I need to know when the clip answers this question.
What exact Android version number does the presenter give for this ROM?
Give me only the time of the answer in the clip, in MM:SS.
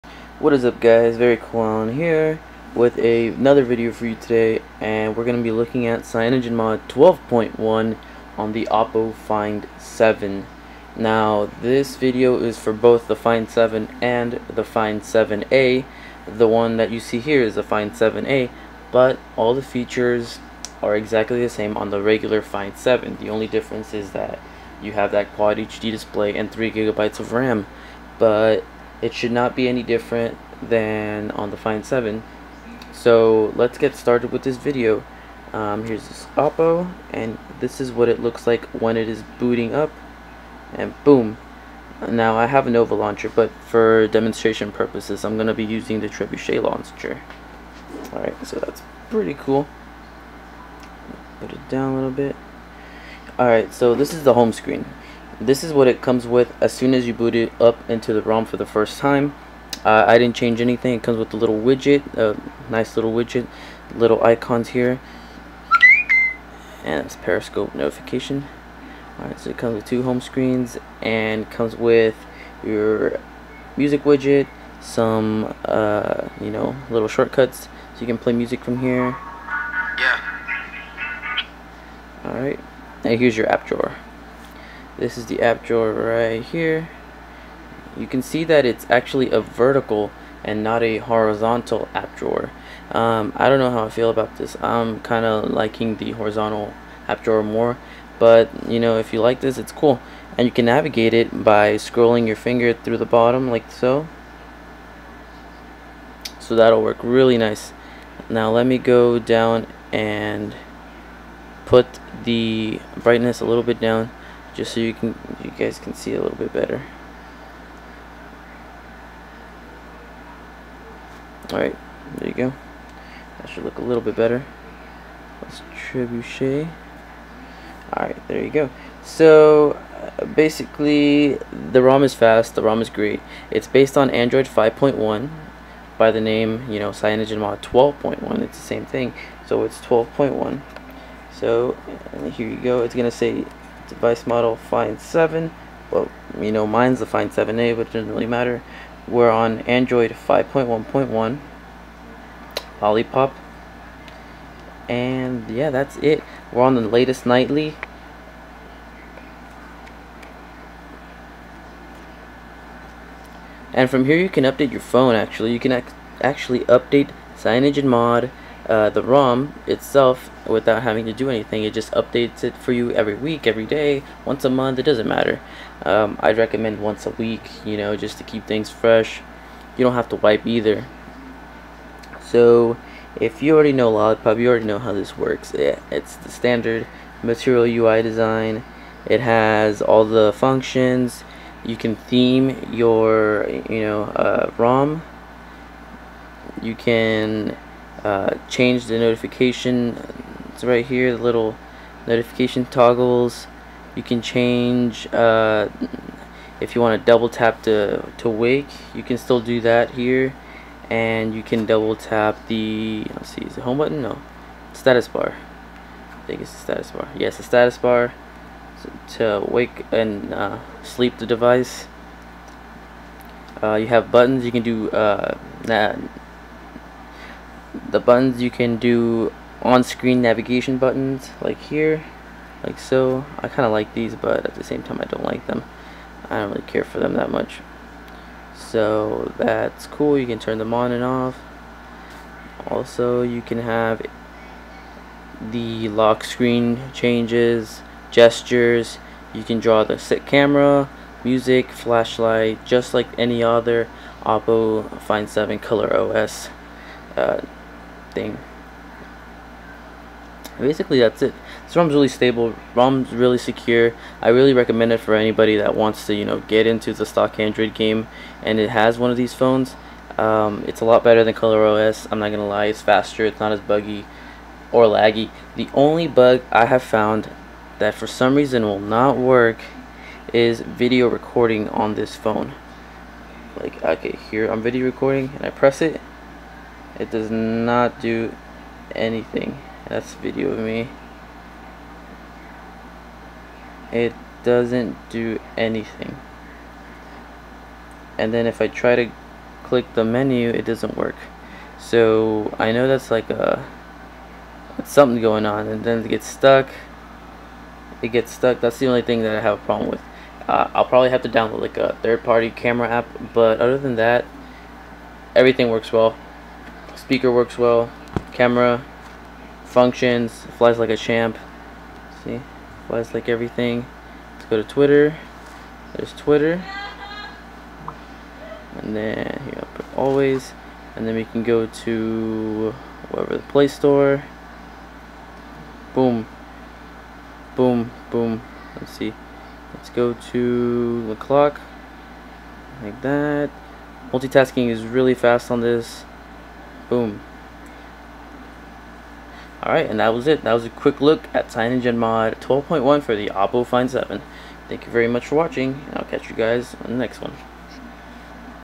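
02:29.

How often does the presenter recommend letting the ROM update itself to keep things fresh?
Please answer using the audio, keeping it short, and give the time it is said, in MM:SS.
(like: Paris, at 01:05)
Once a week, at 02:56.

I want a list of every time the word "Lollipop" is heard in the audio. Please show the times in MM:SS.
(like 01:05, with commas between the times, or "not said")
02:32, 03:03.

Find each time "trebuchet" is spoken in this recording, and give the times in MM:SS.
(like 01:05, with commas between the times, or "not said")
00:46, 02:05.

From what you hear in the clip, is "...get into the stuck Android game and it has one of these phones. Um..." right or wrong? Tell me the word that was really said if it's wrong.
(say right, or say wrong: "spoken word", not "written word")
wrong: "stock", not "stuck".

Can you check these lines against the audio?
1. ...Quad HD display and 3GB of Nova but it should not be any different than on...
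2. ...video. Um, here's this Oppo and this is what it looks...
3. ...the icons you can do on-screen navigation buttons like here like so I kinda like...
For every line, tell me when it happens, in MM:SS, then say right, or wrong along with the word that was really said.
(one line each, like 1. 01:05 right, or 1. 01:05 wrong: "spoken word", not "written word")
1. 00:25 wrong: "RAM", not "Nova"
2. 00:34 right
3. 03:47 wrong: "buttons", not "icons".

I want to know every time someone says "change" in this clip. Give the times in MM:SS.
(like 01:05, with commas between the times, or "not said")
01:00, 03:18, 03:24, 04:06.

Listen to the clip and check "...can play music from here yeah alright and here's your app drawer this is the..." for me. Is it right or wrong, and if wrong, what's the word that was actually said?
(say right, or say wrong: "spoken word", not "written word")
right.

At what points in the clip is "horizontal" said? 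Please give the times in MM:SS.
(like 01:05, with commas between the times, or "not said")
01:30, 01:36.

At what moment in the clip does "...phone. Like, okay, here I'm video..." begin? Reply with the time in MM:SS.
04:42.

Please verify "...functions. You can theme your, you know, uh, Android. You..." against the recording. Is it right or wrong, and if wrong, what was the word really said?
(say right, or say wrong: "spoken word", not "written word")
wrong: "ROM", not "Android".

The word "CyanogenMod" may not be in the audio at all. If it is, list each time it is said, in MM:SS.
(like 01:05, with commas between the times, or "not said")
00:06, 02:16, 02:47, 05:51.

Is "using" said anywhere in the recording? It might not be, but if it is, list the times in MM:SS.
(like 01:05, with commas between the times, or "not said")
00:45.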